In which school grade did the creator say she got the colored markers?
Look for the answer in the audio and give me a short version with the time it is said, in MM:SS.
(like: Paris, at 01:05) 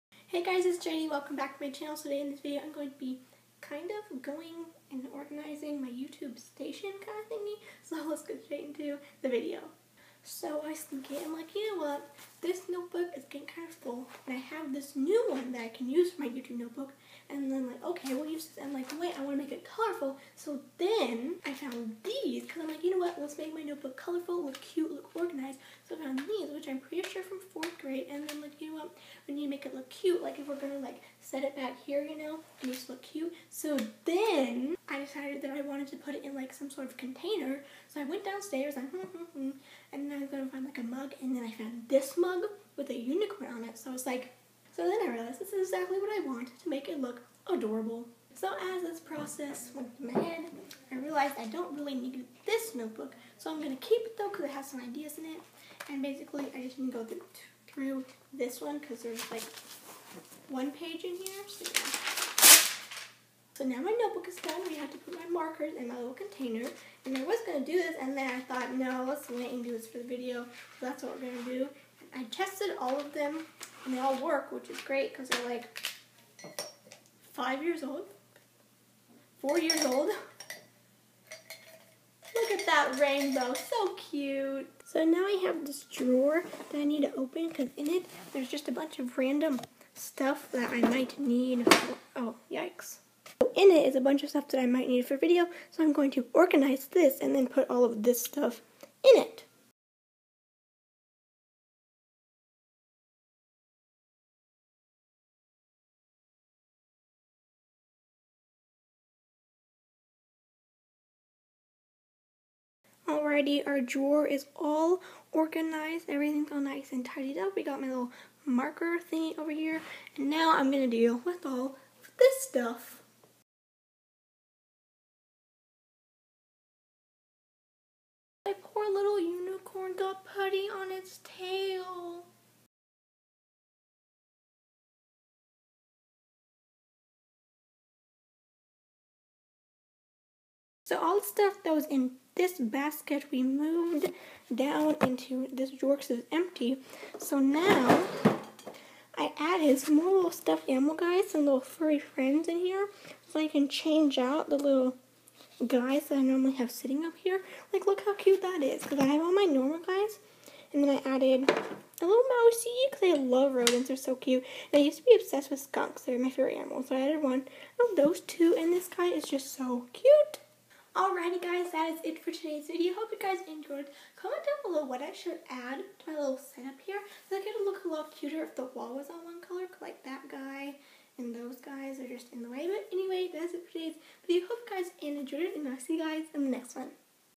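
Fourth grade, at 00:27.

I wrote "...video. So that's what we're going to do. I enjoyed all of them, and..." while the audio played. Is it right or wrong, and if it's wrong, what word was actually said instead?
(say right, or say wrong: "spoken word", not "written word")
wrong: "tested", not "enjoyed".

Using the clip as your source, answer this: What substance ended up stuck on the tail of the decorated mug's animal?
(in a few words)
Putty.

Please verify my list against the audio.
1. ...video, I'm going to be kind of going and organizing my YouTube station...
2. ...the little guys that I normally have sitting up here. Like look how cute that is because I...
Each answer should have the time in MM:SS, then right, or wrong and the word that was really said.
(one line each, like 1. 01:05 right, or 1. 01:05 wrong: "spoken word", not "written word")
1. 00:02 right
2. 02:34 right.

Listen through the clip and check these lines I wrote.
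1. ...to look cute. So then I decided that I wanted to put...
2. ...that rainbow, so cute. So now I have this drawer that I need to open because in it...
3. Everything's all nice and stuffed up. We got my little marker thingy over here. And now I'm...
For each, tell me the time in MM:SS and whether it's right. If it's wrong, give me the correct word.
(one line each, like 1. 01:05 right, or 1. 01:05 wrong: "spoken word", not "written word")
1. 00:32 right
2. 01:22 right
3. 01:56 wrong: "tidied", not "stuffed".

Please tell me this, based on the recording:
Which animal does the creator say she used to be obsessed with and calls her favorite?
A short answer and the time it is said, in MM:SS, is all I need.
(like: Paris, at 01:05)
Skunks, at 02:45.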